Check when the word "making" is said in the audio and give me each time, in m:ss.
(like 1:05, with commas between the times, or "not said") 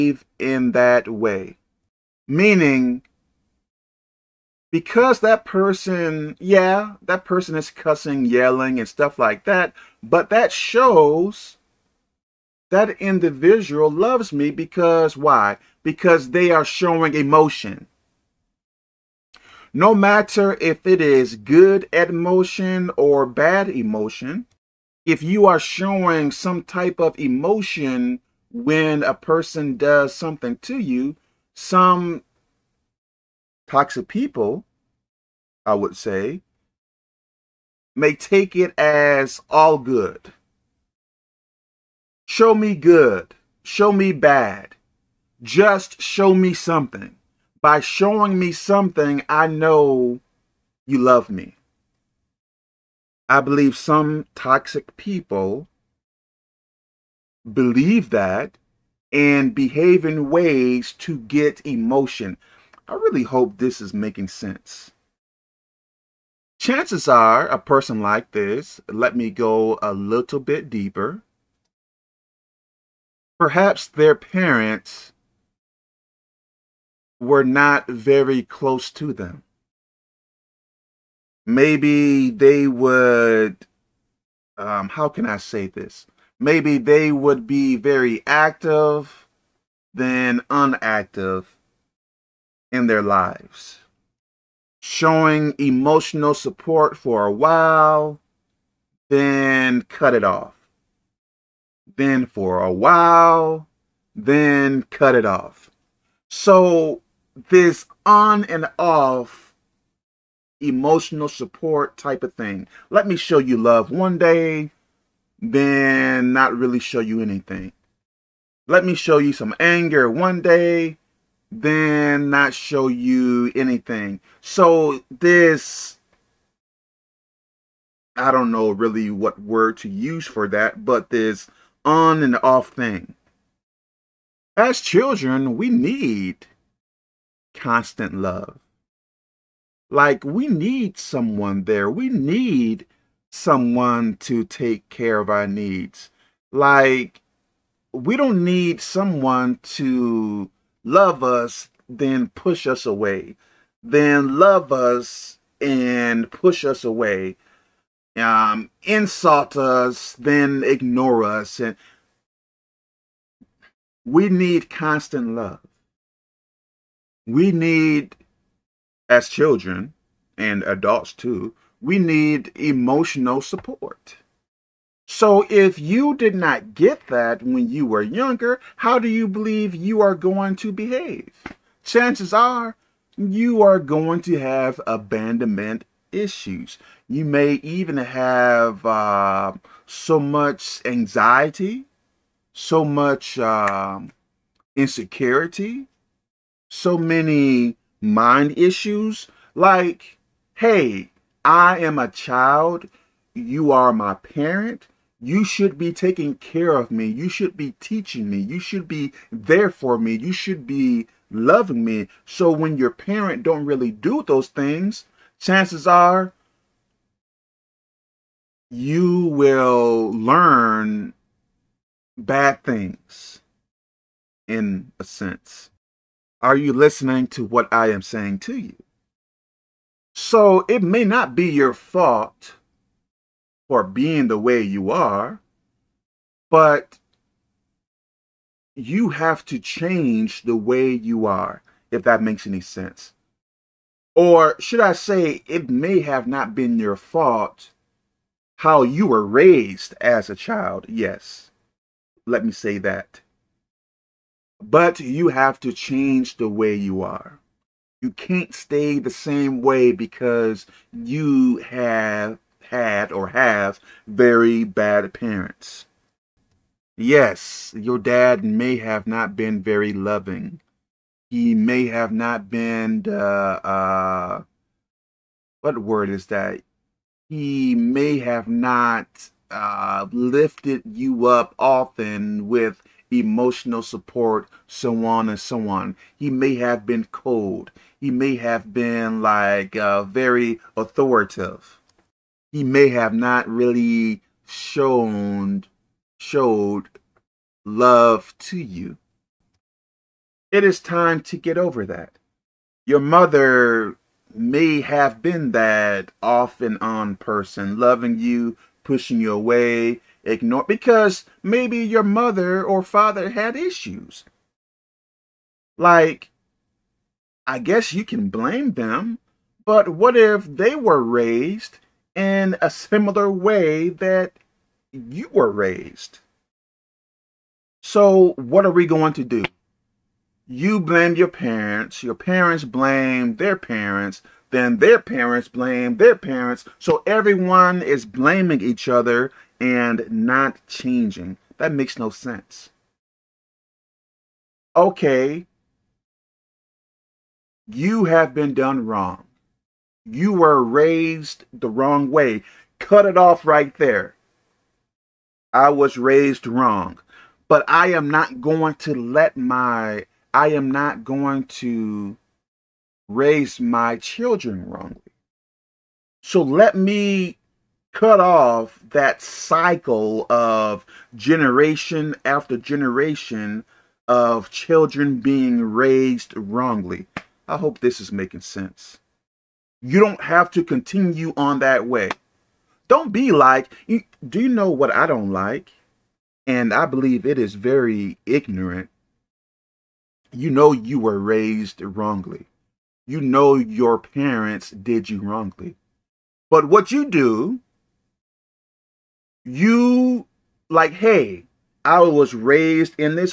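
1:03, 6:18.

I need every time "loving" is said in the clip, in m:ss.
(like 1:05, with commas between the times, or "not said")
3:31, 4:29, 5:07.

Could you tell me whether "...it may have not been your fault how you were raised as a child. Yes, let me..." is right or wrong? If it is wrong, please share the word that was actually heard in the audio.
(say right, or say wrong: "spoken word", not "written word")
right.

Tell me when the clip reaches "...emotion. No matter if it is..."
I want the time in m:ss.
0:17.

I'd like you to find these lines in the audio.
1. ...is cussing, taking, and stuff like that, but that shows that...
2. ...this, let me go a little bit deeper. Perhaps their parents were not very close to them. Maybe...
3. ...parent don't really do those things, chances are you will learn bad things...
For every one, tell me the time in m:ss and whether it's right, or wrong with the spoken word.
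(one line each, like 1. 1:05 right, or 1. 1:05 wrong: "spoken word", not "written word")
1. 0:07 wrong: "yelling", not "taking"
2. 1:08 right
3. 3:32 right.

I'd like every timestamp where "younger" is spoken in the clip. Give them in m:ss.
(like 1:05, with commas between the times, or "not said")
2:58.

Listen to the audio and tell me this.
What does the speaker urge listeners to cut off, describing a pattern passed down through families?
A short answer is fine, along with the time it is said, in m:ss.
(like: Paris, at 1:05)
That cycle, at 6:08.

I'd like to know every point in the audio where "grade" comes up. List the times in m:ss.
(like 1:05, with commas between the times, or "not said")
not said.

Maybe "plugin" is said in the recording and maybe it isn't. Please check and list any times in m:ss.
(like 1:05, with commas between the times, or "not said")
not said.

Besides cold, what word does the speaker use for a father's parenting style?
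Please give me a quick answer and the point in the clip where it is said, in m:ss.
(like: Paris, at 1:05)
Authoritative, at 4:50.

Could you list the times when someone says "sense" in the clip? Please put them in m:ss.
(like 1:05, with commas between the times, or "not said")
1:04, 3:45, 4:02, 5:42, 6:18.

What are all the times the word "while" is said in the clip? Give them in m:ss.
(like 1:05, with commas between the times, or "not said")
1:37, 1:42.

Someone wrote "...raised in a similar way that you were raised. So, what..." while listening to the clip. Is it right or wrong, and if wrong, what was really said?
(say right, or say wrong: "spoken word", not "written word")
right.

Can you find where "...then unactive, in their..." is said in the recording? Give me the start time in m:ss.
1:29.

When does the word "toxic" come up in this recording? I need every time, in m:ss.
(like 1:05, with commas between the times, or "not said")
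0:33, 0:54.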